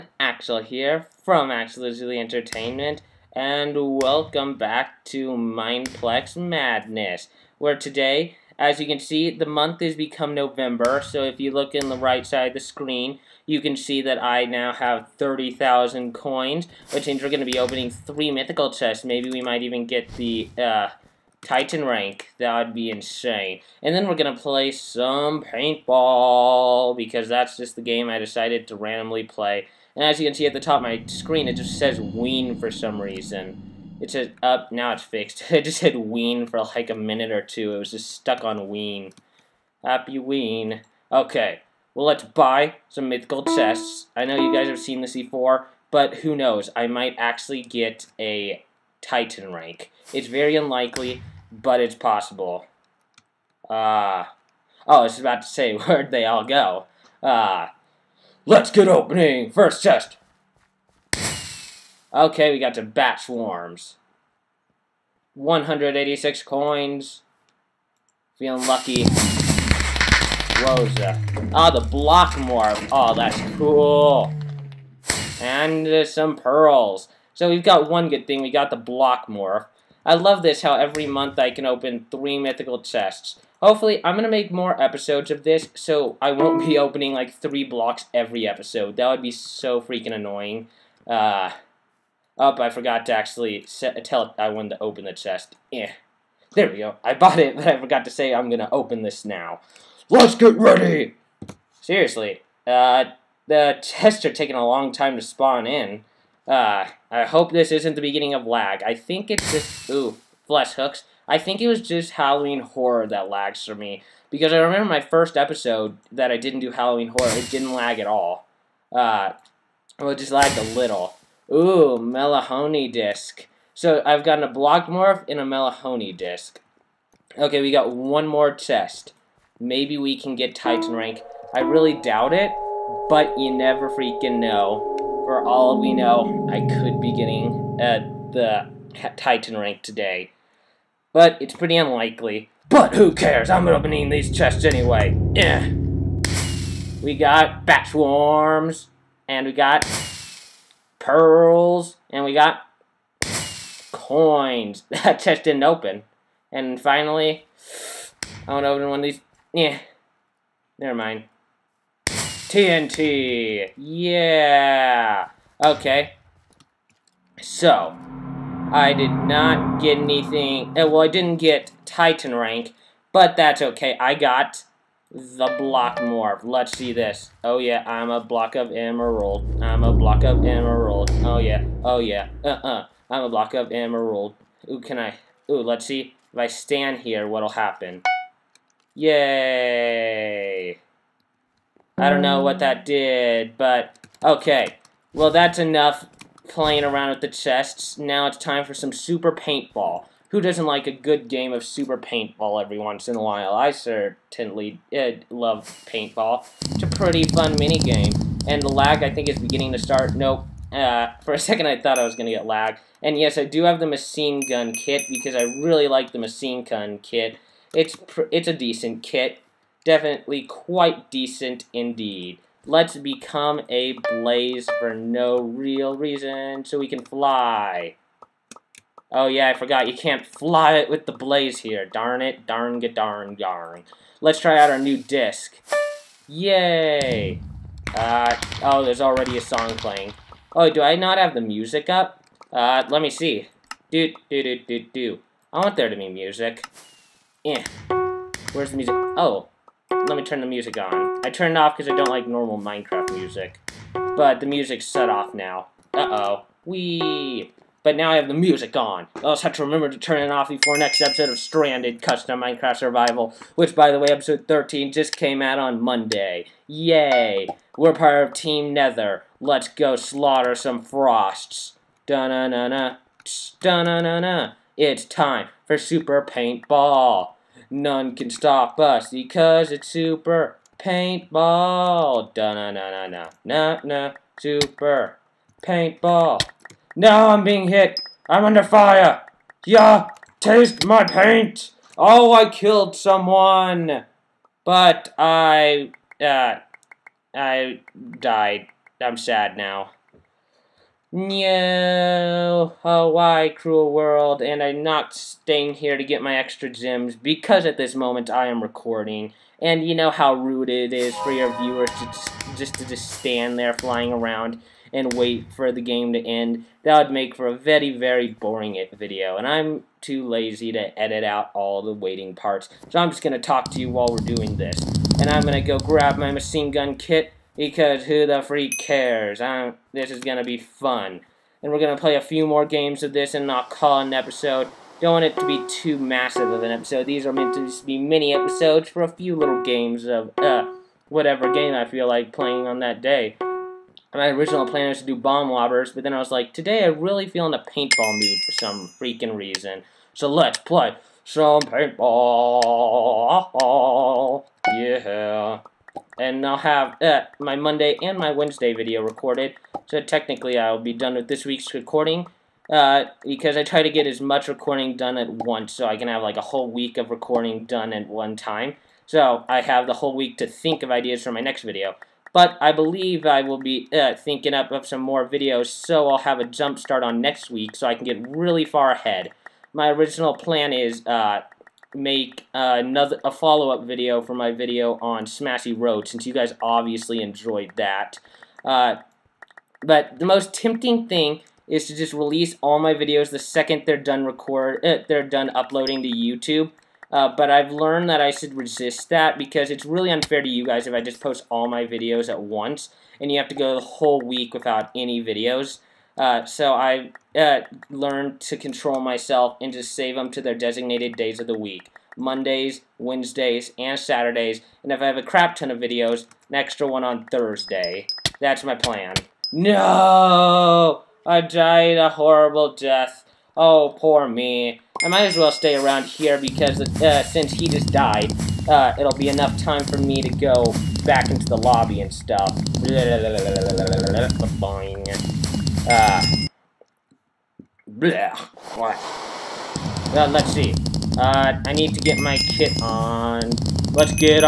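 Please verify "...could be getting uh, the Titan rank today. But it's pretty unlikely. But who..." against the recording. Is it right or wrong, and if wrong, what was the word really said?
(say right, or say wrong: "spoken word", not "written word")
right.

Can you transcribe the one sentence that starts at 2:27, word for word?
We got bat swarms, and we got pearls, and we got coins.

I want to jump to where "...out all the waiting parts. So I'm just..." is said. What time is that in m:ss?
5:21.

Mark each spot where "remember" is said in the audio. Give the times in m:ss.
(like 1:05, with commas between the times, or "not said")
1:54, 4:19.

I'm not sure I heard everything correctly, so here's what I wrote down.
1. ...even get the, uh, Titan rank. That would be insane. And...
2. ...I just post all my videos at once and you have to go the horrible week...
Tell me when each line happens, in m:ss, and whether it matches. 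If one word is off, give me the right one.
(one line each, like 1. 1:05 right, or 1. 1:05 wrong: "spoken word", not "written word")
1. 0:19 right
2. 6:40 wrong: "whole", not "horrible".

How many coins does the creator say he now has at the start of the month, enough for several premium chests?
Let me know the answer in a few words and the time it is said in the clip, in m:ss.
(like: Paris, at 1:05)
30,000, at 0:15.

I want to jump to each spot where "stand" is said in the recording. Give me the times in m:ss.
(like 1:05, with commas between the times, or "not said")
3:06, 5:13.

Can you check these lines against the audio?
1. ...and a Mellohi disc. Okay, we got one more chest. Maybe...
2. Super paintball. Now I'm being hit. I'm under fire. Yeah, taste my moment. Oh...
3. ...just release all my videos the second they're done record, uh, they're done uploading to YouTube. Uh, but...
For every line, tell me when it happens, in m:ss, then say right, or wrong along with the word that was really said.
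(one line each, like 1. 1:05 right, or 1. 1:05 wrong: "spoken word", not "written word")
1. 2:05 right
2. 4:44 wrong: "paint", not "moment"
3. 6:31 right.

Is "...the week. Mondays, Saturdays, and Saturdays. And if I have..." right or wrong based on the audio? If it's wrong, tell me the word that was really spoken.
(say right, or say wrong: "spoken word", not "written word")
wrong: "Wednesdays", not "Saturdays".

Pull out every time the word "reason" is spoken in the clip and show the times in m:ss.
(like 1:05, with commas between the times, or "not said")
0:32, 3:45, 5:49.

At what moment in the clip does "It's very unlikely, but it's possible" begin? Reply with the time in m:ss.
0:50.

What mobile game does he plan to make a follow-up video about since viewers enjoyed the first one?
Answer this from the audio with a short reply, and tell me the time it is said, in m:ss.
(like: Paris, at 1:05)
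Smashy Road, at 6:25.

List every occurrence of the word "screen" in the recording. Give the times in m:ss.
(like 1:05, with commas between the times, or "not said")
0:12, 0:31.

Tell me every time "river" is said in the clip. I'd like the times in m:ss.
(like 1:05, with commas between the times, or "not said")
not said.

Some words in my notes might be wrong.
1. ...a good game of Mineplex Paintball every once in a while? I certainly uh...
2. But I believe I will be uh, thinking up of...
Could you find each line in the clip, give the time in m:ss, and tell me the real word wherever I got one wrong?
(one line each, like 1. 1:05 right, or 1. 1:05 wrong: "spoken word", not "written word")
1. 3:20 wrong: "Super", not "Mineplex"
2. 6:12 right.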